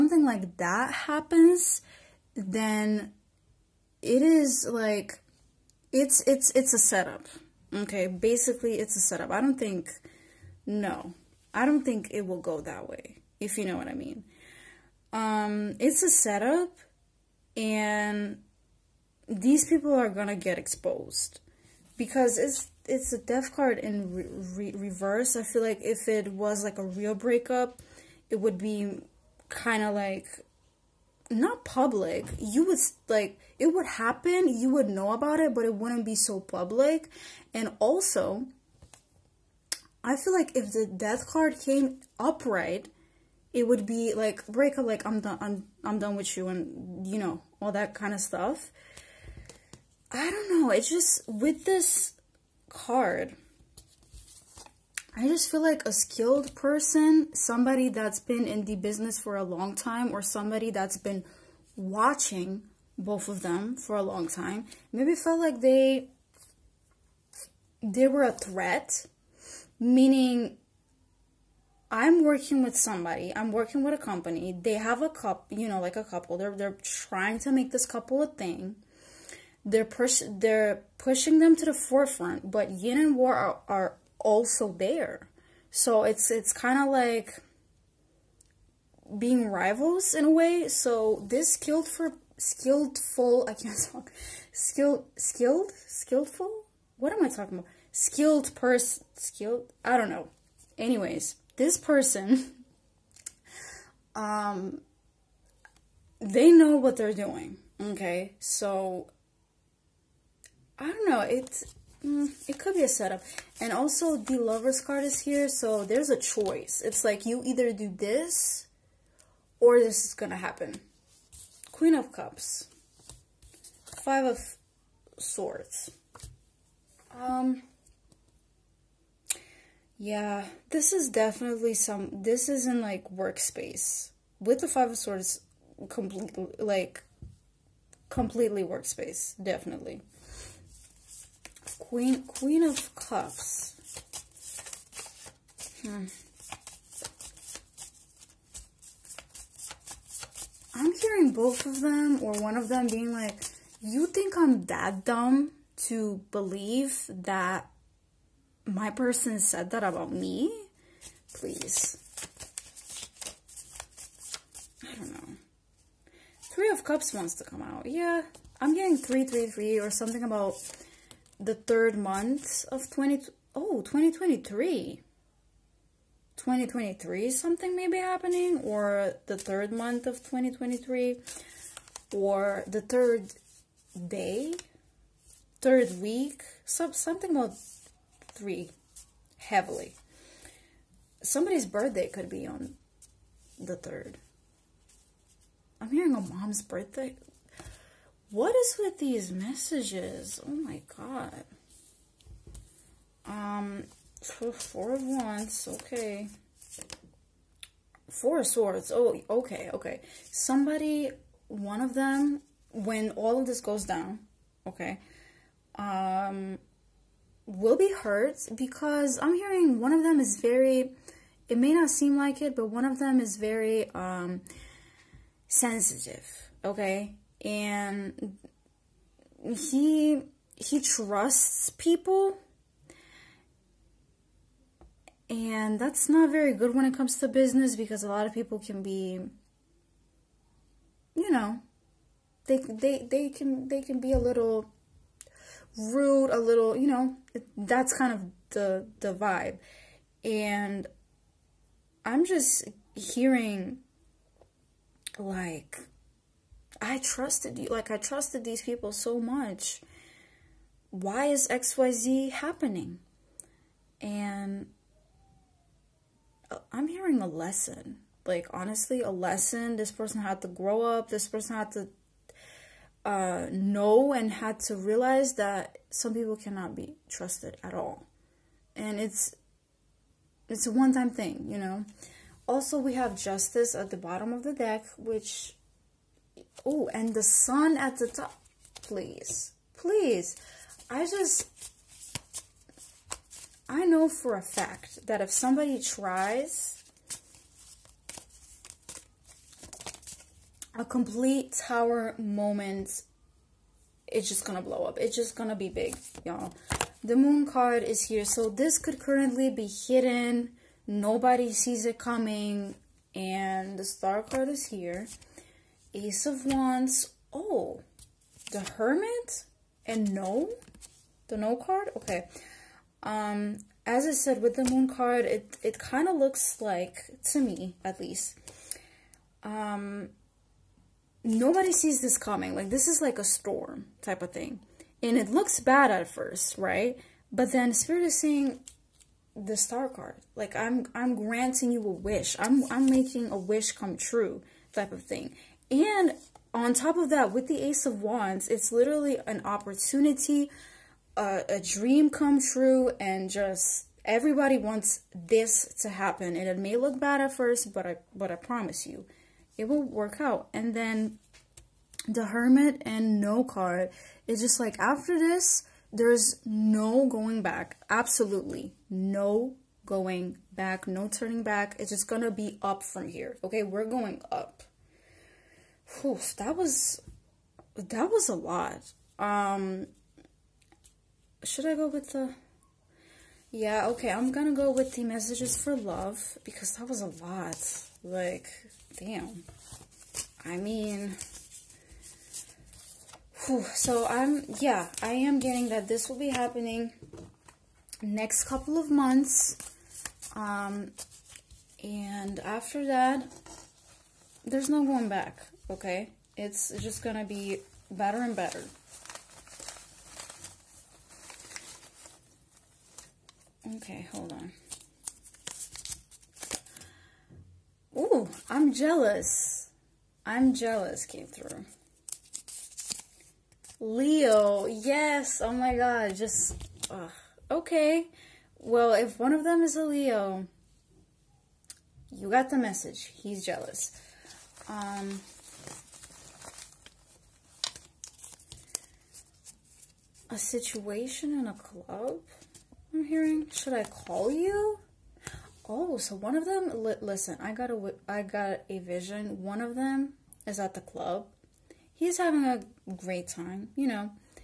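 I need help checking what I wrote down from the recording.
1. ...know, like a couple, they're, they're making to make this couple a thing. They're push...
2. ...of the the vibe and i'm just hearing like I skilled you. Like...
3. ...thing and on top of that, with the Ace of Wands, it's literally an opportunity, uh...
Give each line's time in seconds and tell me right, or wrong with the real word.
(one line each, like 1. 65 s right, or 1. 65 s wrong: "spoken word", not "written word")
1. 75 s wrong: "trying", not "making"
2. 248 s wrong: "trusted", not "skilled"
3. 345 s right.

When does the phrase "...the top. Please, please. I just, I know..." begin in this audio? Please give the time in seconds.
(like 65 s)
287 s.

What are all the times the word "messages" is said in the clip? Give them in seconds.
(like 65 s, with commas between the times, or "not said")
199 s, 385 s, 432 s.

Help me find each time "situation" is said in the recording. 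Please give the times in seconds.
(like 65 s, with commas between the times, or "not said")
440 s.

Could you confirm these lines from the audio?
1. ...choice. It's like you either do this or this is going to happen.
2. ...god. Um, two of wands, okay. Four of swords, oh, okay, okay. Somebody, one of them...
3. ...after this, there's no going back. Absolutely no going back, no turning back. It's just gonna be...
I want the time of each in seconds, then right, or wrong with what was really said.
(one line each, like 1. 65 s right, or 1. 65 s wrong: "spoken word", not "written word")
1. 116 s right
2. 200 s wrong: "four", not "two"
3. 364 s right.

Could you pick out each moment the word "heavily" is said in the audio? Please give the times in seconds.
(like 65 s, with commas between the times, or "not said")
189 s.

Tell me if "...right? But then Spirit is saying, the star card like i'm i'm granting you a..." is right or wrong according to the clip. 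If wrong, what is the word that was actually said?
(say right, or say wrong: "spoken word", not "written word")
right.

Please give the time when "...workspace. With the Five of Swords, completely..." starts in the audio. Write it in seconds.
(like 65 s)
133 s.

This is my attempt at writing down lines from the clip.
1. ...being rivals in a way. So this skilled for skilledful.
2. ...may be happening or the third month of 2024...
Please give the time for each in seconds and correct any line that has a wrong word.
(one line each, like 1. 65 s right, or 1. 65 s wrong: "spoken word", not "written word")
1. 89 s right
2. 177 s wrong: "2023", not "2024".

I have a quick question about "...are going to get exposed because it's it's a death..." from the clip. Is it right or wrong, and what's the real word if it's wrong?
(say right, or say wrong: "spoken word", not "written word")
right.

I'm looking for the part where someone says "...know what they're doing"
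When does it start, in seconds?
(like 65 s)
106 s.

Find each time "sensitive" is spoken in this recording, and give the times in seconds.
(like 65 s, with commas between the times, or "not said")
225 s.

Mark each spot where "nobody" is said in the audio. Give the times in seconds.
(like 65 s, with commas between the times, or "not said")
310 s, 331 s.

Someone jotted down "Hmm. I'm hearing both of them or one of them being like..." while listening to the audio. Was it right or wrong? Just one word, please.
right.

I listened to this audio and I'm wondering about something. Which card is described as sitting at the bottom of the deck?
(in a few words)
Justice.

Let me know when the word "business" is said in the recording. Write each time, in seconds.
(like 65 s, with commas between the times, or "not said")
58 s, 237 s.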